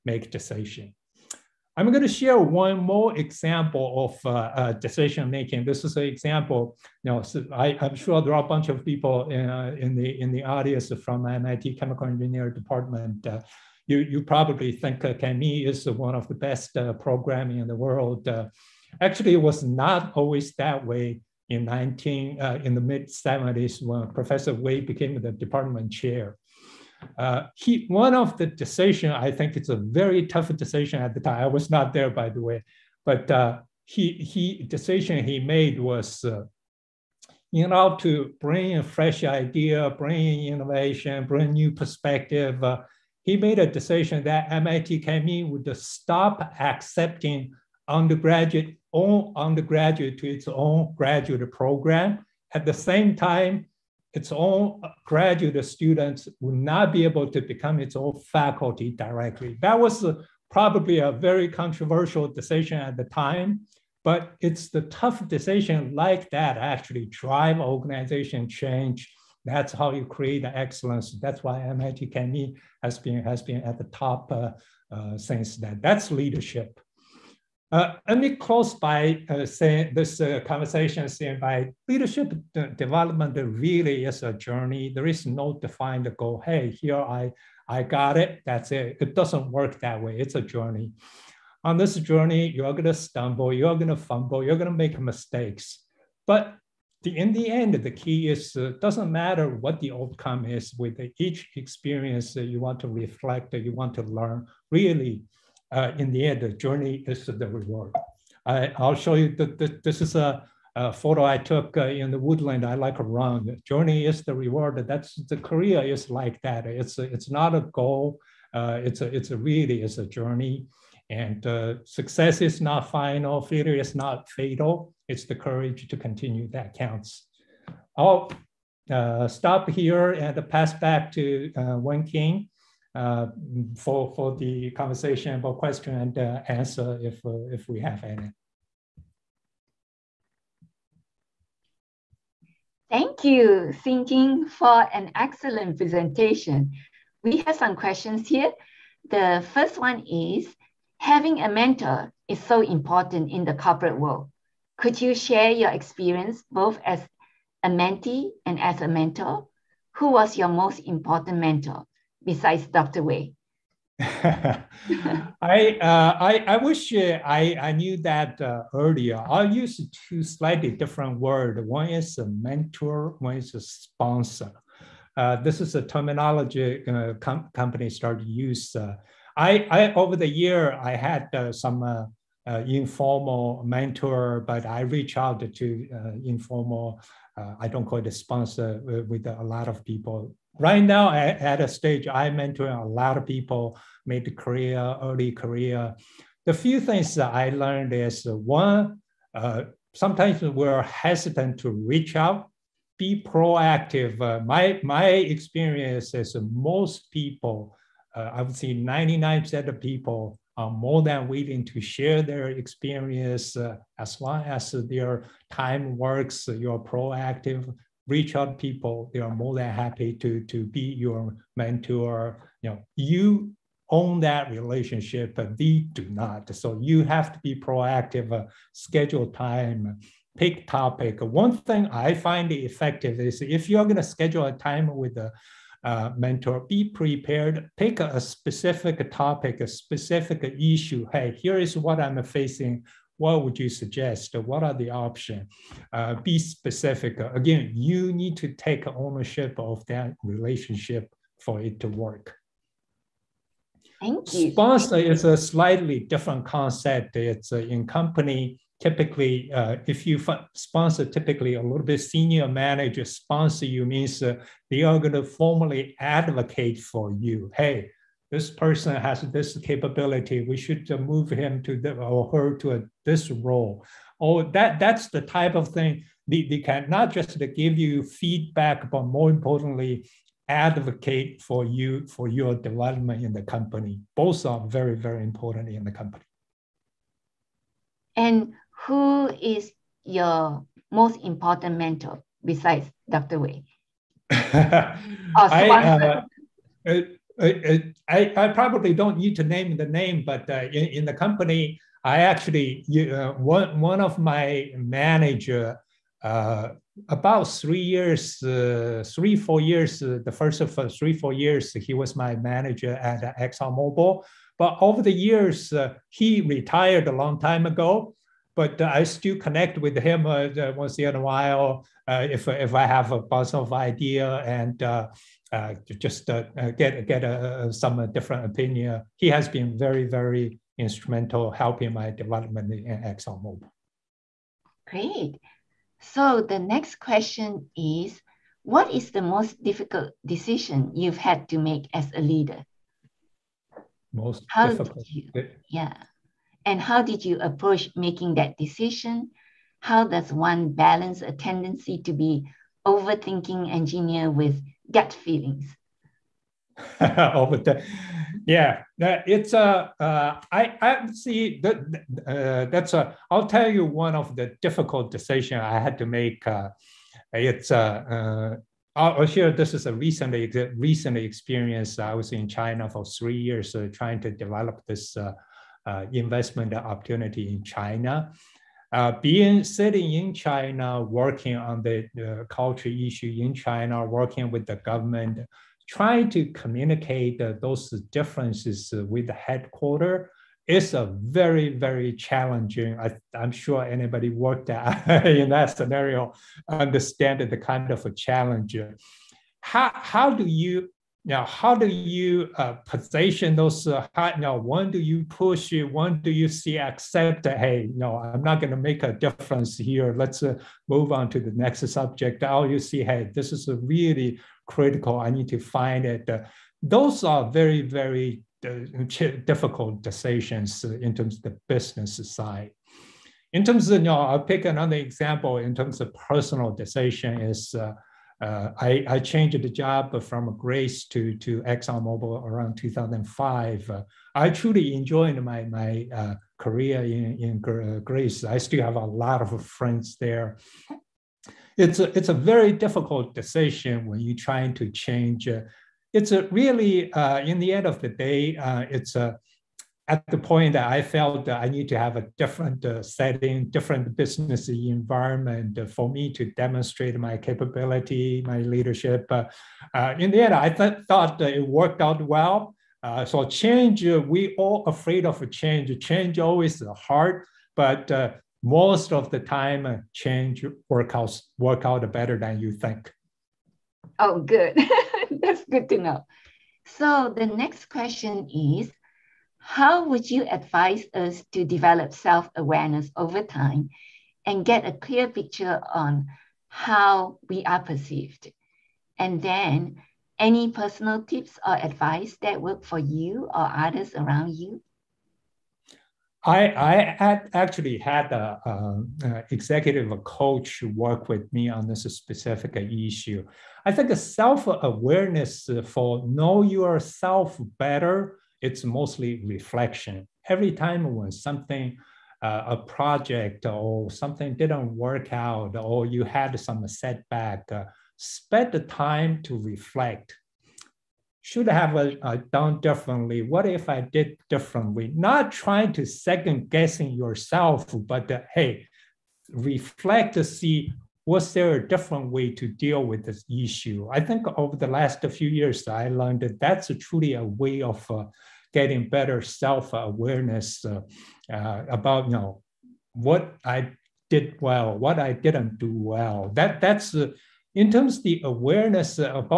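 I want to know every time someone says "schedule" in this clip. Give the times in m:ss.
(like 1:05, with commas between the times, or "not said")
3:48, 3:54.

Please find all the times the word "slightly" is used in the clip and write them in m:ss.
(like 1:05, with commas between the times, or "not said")
2:50, 4:15.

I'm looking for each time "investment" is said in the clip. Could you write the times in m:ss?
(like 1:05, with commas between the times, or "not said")
6:16.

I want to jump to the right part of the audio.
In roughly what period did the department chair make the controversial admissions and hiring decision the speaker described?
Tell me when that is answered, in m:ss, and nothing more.
0:22.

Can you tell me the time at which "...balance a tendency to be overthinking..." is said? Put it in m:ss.
5:50.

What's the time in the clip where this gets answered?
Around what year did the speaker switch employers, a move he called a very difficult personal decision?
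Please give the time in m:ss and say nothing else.
7:12.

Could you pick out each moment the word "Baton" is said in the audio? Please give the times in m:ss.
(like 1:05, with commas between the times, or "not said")
not said.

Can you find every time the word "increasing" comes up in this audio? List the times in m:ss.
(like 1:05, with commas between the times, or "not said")
not said.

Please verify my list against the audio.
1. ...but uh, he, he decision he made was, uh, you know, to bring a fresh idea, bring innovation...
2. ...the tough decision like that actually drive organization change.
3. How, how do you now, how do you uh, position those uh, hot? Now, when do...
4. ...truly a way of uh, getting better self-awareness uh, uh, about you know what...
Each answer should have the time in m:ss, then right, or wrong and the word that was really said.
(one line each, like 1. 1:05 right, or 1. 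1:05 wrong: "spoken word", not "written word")
1. 0:33 right
2. 1:04 right
3. 6:39 right
4. 8:56 right.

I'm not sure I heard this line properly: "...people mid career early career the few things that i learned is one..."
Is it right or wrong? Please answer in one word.
right.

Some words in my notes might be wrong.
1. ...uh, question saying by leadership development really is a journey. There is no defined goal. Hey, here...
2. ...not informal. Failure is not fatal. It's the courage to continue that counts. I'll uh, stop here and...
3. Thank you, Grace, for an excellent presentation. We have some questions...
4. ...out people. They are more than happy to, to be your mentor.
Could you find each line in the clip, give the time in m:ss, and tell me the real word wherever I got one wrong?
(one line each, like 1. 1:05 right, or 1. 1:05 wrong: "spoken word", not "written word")
1. 1:20 wrong: "conversation", not "question"
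2. 2:02 wrong: "final", not "informal"
3. 2:22 wrong: "Xinjin", not "Grace"
4. 3:38 right.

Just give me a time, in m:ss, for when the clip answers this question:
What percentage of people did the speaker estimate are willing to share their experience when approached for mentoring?
3:28.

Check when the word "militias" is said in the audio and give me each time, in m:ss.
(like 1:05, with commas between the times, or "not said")
not said.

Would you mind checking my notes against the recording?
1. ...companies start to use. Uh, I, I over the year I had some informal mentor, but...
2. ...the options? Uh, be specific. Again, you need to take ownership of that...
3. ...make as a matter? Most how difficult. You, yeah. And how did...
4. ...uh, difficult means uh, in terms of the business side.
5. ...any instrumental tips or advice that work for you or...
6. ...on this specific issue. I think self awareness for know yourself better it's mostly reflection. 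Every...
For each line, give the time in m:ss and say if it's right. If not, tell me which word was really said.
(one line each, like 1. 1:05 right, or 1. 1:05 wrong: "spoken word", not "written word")
1. 2:57 right
2. 4:04 right
3. 5:41 wrong: "leader", not "matter"
4. 6:58 wrong: "decisions", not "means"
5. 8:10 wrong: "personal", not "instrumental"
6. 8:21 right.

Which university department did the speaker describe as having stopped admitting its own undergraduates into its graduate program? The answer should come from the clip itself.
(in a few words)
MIT Chemical Engineering.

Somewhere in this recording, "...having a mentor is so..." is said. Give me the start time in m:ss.
2:30.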